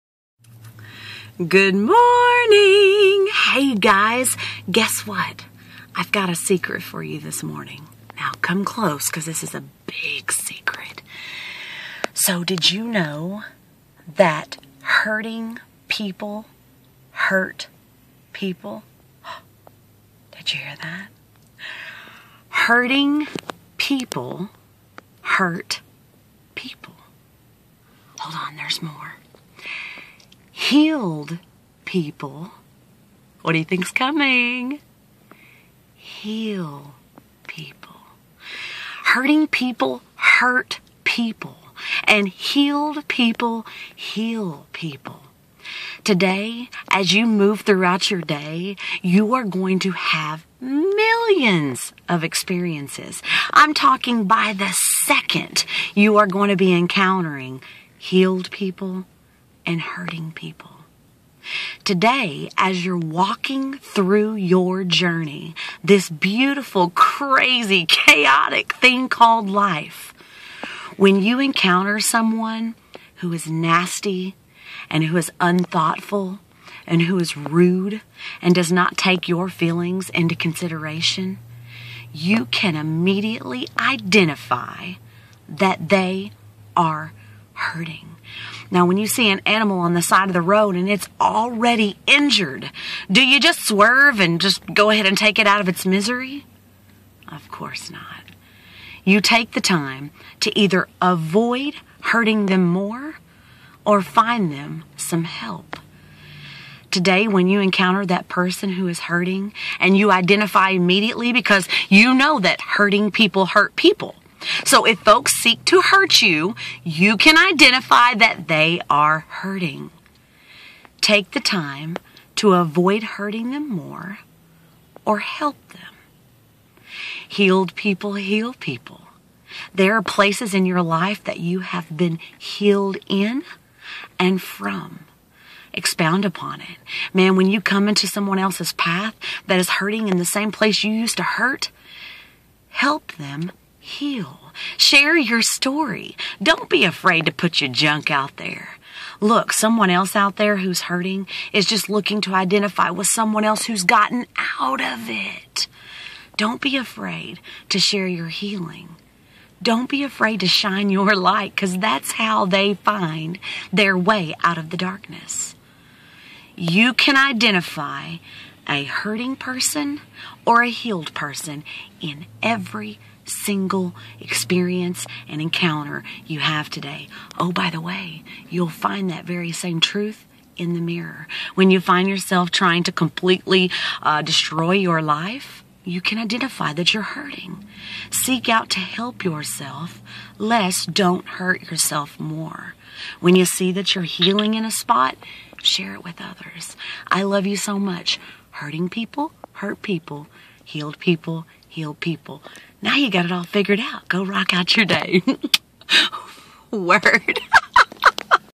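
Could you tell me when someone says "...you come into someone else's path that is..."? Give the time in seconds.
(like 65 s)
137 s.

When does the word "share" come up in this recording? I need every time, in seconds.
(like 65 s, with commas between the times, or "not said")
144 s, 157 s, 195 s.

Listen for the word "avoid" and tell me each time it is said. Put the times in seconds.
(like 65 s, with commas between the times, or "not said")
101 s, 122 s.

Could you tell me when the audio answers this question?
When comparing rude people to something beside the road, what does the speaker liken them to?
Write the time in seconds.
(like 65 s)
89 s.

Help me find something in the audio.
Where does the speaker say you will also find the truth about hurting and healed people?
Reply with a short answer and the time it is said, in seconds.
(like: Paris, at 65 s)
the mirror, at 180 s.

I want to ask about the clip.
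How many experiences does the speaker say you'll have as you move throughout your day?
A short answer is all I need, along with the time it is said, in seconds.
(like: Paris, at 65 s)
millions, at 50 s.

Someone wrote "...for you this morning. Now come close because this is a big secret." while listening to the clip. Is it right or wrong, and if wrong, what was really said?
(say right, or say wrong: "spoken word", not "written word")
right.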